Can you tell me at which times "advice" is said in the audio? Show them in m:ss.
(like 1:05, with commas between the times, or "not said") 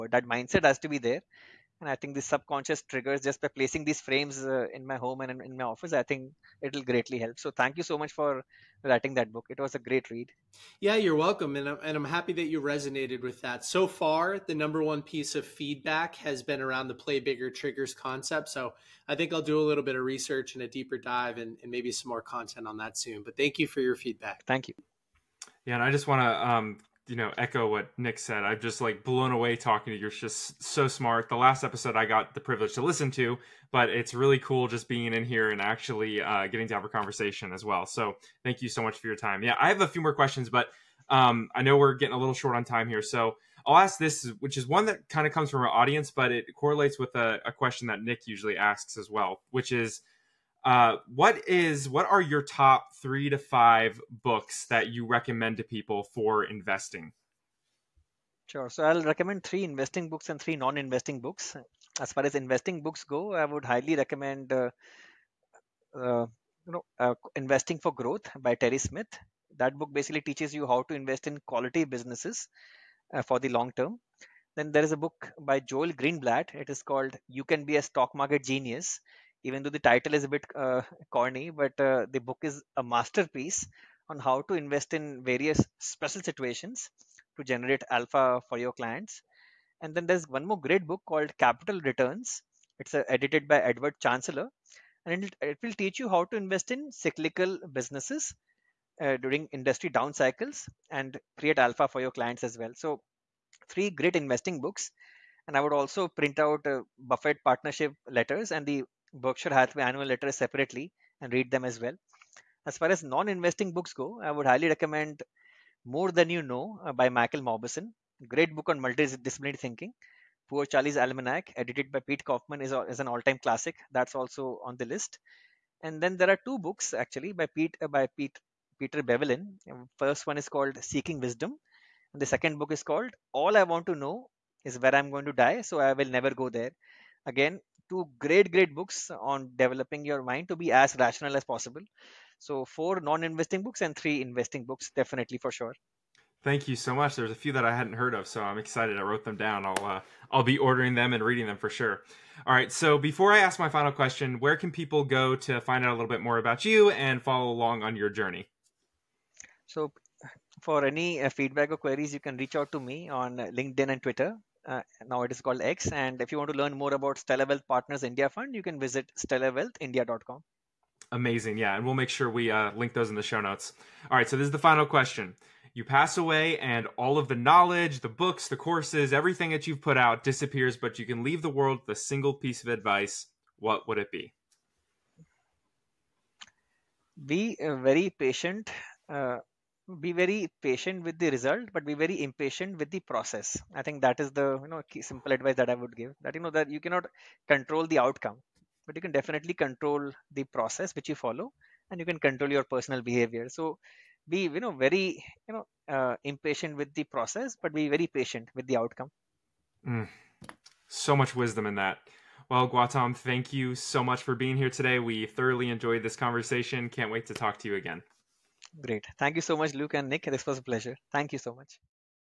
3:02, 3:15.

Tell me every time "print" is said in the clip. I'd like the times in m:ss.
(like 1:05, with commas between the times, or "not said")
1:46.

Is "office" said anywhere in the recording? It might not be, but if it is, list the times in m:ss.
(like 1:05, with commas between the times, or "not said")
0:05.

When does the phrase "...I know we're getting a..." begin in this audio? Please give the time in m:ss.
0:41.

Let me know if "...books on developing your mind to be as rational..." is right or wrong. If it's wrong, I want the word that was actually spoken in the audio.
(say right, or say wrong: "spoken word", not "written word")
right.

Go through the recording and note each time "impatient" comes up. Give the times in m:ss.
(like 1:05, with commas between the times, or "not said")
3:12, 3:26.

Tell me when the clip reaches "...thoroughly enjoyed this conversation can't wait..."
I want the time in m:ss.
3:35.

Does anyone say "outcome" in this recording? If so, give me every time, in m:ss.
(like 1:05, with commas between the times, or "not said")
3:17, 3:28.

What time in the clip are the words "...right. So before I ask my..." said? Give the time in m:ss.
2:32.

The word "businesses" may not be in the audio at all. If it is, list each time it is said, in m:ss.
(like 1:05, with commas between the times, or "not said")
1:11, 1:37.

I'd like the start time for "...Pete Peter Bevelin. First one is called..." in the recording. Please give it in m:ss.
2:08.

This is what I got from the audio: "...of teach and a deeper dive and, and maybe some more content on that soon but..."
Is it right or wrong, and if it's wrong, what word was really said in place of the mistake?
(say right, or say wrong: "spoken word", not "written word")
wrong: "research", not "teach".